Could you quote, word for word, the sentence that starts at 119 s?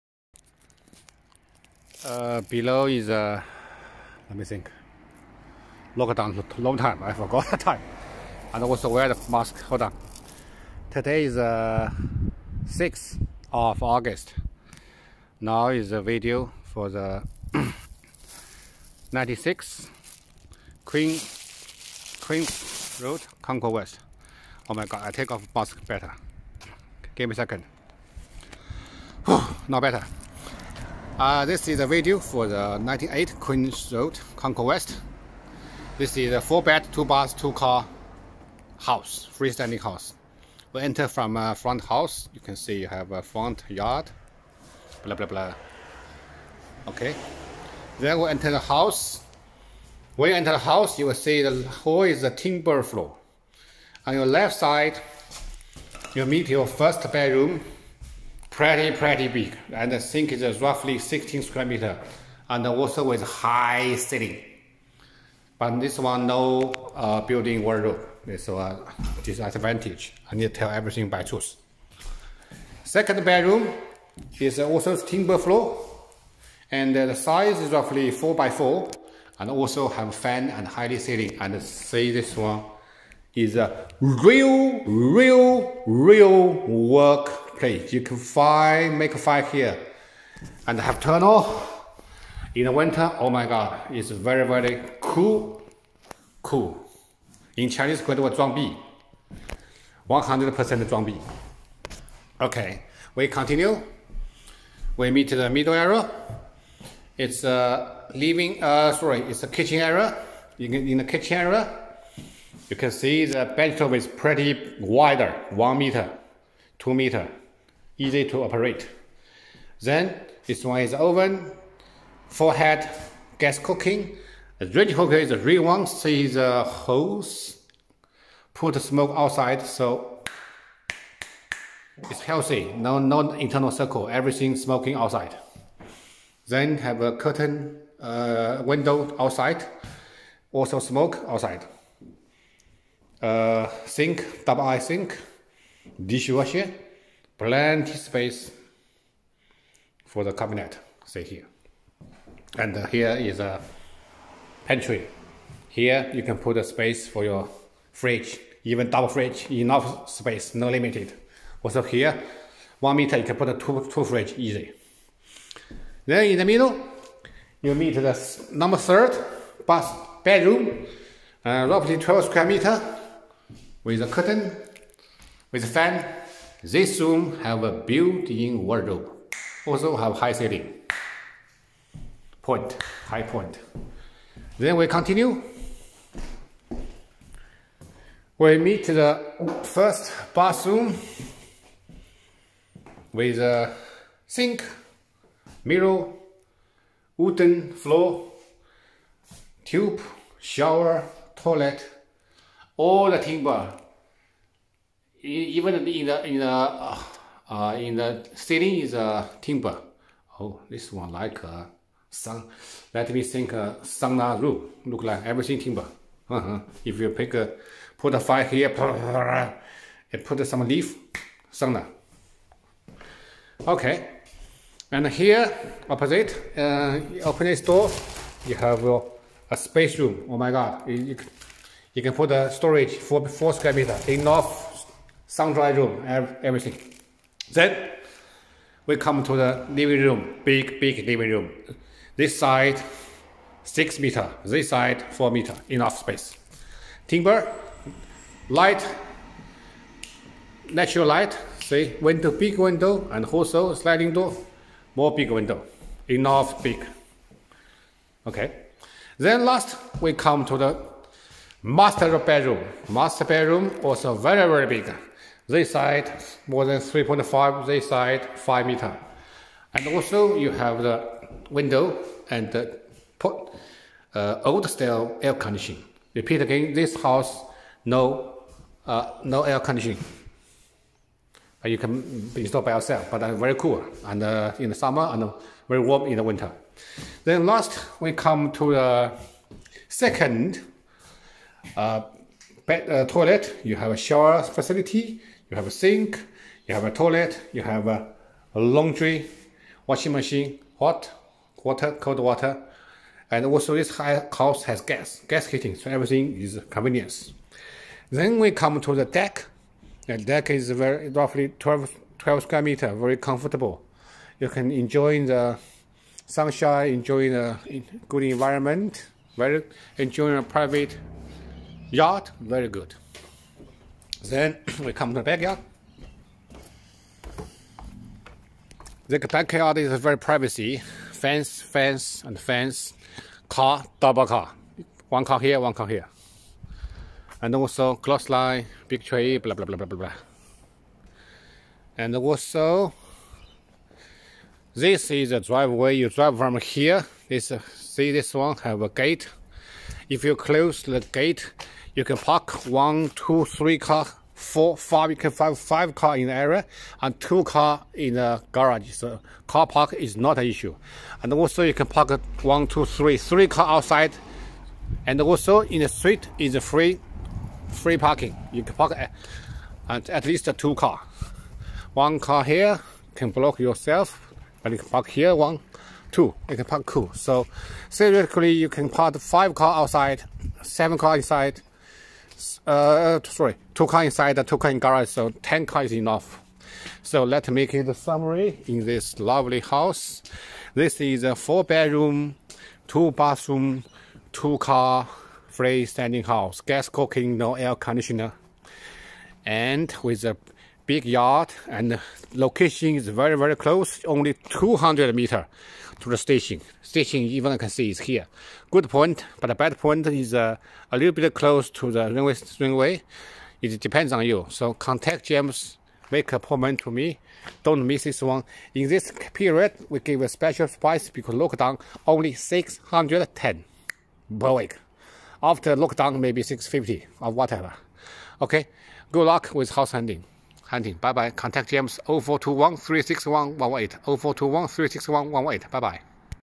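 Then this one is oven, forehead, gas cooking.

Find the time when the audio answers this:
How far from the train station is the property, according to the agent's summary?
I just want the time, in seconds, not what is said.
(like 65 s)
404 s.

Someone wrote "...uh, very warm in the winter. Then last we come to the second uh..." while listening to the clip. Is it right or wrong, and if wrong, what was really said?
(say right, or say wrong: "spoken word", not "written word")
right.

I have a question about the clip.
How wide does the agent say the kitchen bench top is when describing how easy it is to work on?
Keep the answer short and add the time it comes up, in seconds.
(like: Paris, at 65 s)
2 meters, at 116 s.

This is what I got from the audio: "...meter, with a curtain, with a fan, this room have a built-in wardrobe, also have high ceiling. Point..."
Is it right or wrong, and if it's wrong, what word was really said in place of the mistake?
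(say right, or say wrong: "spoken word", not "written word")
right.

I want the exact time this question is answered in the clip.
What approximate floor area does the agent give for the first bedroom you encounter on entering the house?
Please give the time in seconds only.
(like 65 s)
60 s.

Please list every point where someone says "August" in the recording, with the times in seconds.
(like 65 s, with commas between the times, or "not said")
13 s.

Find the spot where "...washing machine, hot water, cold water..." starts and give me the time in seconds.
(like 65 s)
299 s.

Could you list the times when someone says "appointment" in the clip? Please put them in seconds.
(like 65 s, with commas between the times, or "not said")
416 s.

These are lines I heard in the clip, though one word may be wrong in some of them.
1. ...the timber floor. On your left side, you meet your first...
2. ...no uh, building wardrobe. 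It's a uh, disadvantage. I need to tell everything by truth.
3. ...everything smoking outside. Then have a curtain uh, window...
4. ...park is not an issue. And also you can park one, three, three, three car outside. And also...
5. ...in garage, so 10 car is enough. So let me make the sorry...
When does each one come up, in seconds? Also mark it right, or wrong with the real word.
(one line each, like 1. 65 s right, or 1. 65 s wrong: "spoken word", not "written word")
1. 52 s right
2. 66 s right
3. 134 s right
4. 359 s wrong: "two", not "three"
5. 384 s wrong: "summary", not "sorry".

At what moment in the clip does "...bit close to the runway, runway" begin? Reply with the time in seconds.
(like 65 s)
411 s.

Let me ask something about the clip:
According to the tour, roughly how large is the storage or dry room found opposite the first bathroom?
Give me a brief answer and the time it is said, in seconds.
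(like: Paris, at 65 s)
4 square meters, at 233 s.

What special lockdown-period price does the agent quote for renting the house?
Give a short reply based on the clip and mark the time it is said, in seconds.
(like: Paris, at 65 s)
610, at 422 s.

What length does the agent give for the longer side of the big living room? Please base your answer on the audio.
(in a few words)
6 meters.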